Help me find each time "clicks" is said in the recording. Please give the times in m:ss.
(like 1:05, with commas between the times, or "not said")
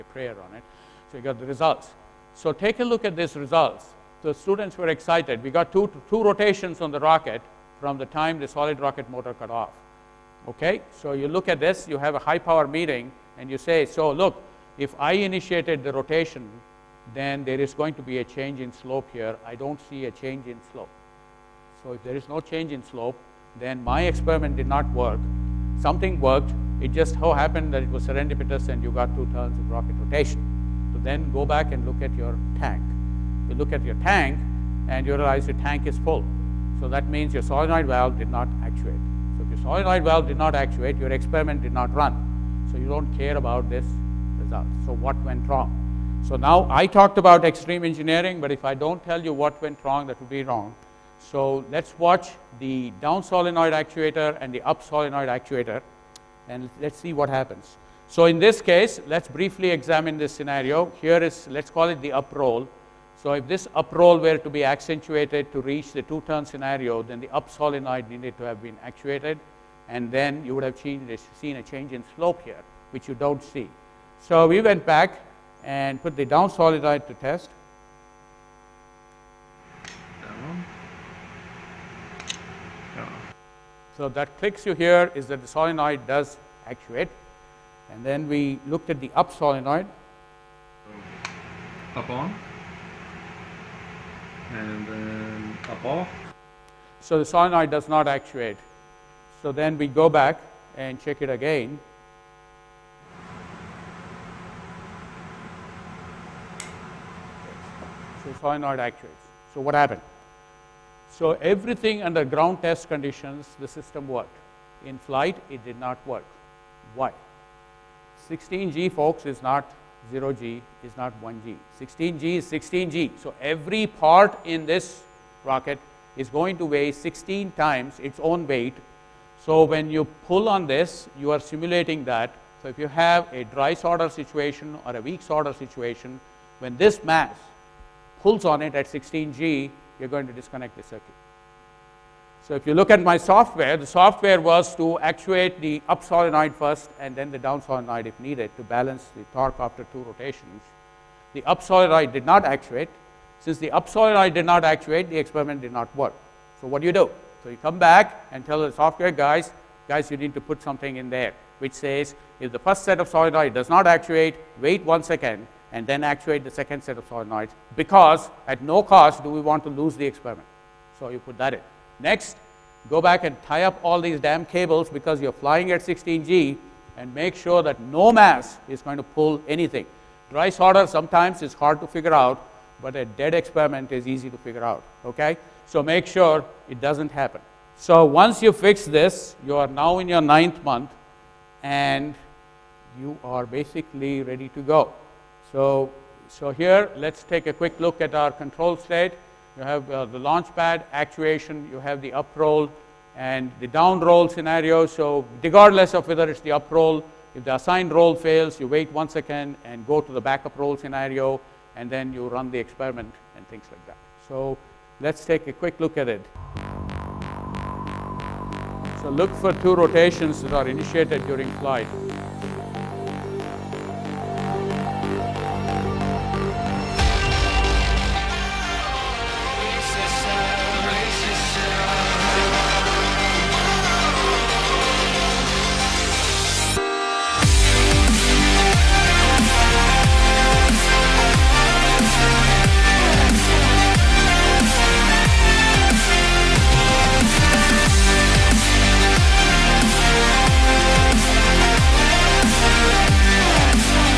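1:24.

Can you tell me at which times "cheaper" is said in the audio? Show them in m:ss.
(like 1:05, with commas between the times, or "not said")
not said.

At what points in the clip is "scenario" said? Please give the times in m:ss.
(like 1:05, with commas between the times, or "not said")
1:00, 1:06, 3:24, 3:30.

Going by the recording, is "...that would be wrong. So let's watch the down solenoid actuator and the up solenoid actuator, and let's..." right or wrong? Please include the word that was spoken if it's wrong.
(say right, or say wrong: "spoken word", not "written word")
right.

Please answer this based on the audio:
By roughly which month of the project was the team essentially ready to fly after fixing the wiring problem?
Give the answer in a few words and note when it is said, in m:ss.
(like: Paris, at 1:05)
9th month, at 3:10.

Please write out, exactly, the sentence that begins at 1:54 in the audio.
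In flight, it did not work.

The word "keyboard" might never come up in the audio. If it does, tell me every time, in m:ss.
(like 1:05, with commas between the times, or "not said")
not said.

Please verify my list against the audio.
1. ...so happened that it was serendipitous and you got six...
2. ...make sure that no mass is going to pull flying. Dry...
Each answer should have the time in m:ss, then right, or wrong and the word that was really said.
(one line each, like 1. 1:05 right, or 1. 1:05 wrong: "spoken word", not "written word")
1. 0:27 wrong: "two", not "six"
2. 2:57 wrong: "anything", not "flying".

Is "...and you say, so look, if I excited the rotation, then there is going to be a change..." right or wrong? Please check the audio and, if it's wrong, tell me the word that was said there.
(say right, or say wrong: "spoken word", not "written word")
wrong: "initiated", not "excited".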